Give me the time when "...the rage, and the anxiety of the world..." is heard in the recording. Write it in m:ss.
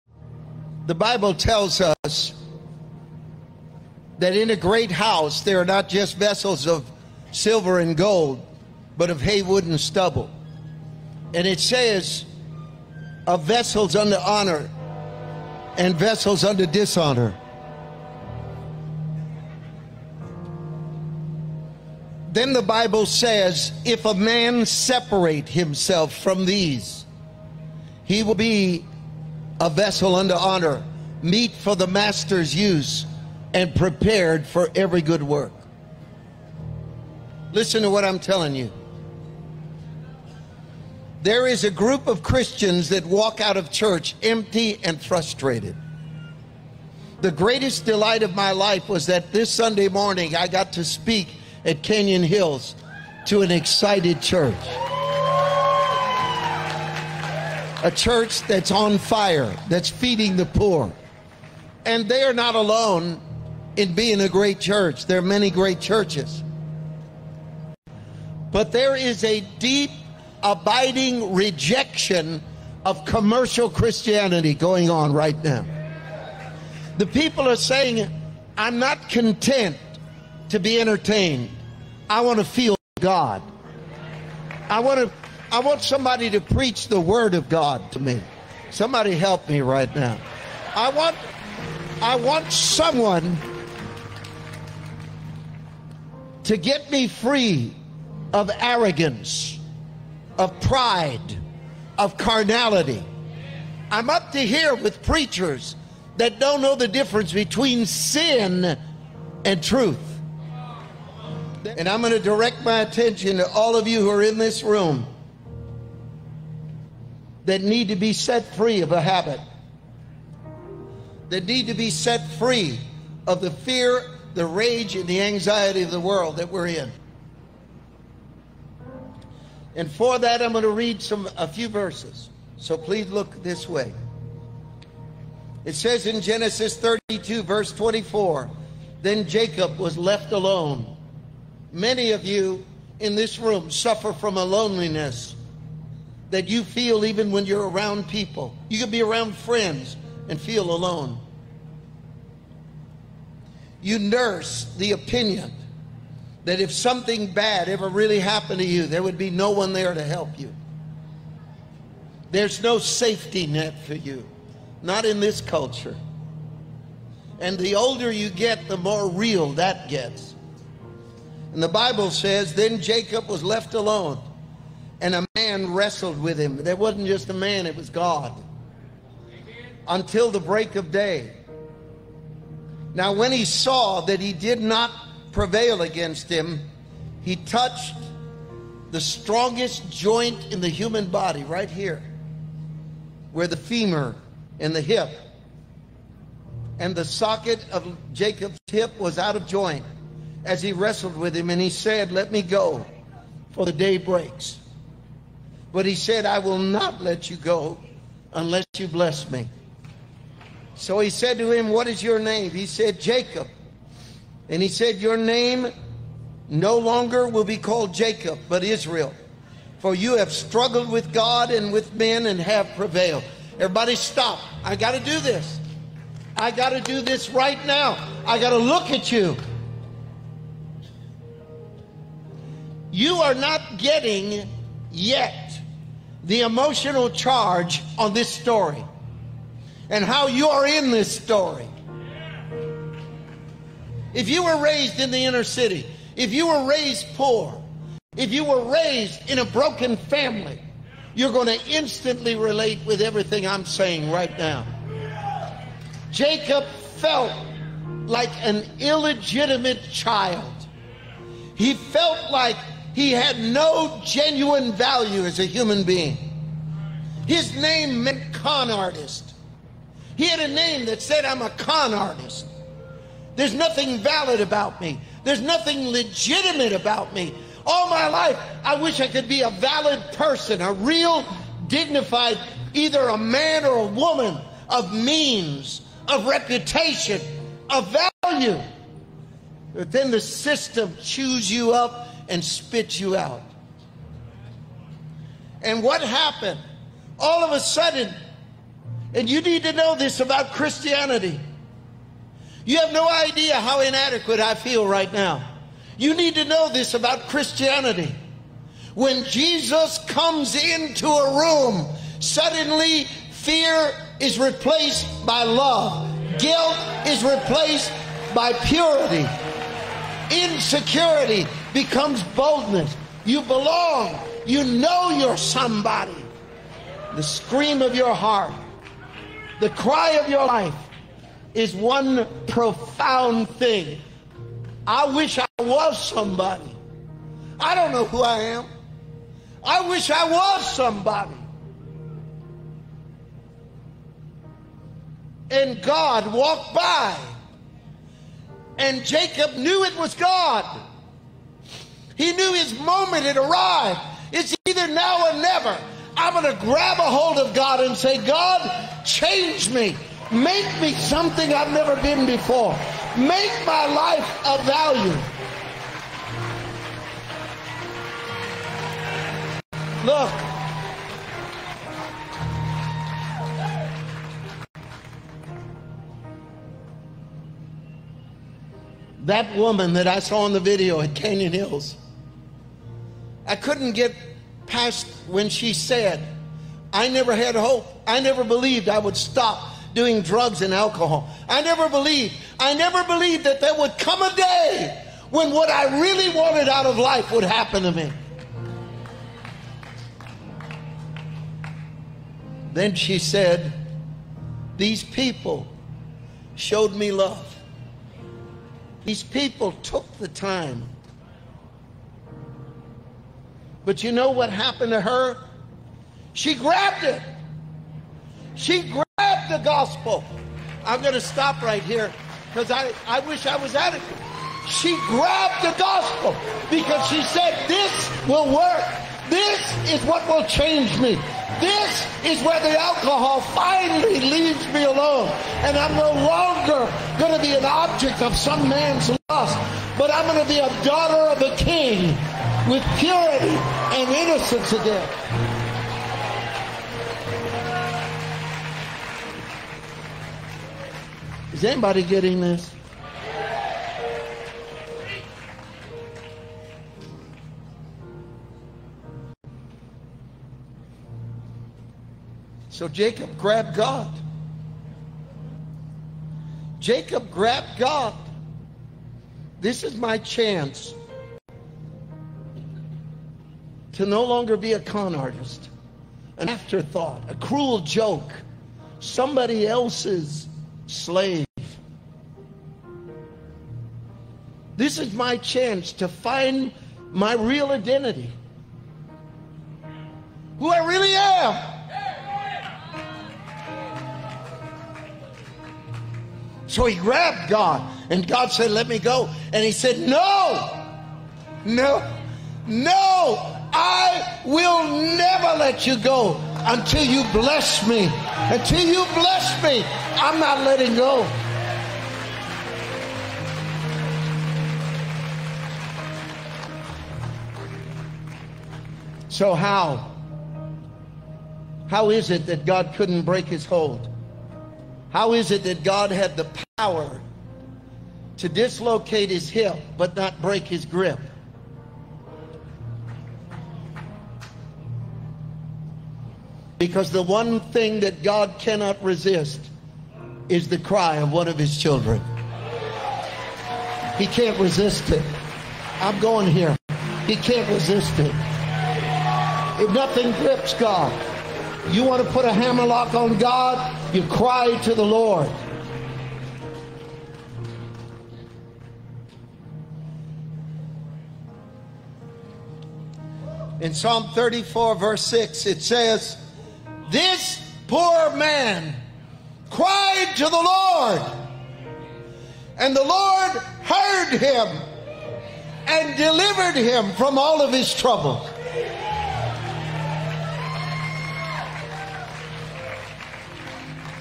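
2:04.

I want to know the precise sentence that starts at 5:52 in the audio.
He knew his moment had arrived.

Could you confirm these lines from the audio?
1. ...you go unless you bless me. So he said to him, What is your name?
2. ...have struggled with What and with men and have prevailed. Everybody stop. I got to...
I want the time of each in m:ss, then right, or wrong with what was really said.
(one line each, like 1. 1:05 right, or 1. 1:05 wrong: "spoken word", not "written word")
1. 3:27 right
2. 3:40 wrong: "God", not "What".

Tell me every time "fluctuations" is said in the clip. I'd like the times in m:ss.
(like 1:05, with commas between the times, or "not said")
not said.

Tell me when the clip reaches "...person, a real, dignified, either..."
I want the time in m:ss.
4:40.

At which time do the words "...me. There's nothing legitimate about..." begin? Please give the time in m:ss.
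4:34.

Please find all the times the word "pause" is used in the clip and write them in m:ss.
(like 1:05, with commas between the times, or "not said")
not said.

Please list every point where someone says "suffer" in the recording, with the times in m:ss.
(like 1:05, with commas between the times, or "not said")
2:23.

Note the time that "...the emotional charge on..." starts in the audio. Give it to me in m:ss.
3:56.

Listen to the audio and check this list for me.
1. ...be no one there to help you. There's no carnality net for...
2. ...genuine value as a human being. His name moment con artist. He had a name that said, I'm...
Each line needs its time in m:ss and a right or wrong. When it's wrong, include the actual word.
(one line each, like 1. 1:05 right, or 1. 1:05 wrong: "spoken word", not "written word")
1. 2:39 wrong: "safety", not "carnality"
2. 4:24 wrong: "meant", not "moment".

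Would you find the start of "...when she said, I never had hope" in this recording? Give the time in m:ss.
6:25.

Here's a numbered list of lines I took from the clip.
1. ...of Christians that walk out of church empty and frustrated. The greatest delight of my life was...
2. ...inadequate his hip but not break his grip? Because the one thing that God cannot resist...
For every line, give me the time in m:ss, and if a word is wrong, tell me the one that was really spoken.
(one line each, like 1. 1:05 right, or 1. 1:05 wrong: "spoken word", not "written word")
1. 0:42 right
2. 8:48 wrong: "dislocate", not "inadequate".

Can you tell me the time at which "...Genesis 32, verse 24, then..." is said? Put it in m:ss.
2:16.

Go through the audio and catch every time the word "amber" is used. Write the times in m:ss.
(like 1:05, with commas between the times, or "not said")
not said.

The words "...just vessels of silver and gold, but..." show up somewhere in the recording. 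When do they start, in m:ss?
0:05.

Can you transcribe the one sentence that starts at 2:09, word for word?
And for that, I'm going to read some a few verses.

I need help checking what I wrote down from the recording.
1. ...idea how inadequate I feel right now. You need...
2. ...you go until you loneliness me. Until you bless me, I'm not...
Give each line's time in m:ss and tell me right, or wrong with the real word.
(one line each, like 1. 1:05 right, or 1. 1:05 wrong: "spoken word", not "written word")
1. 5:03 right
2. 8:25 wrong: "bless", not "loneliness".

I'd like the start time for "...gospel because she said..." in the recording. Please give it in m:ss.
7:05.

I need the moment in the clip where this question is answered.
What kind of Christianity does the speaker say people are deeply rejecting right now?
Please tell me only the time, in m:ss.
1:13.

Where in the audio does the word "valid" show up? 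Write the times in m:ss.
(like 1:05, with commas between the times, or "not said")
4:33, 4:39.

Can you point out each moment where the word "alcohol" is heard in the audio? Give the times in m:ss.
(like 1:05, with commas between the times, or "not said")
6:30, 7:12.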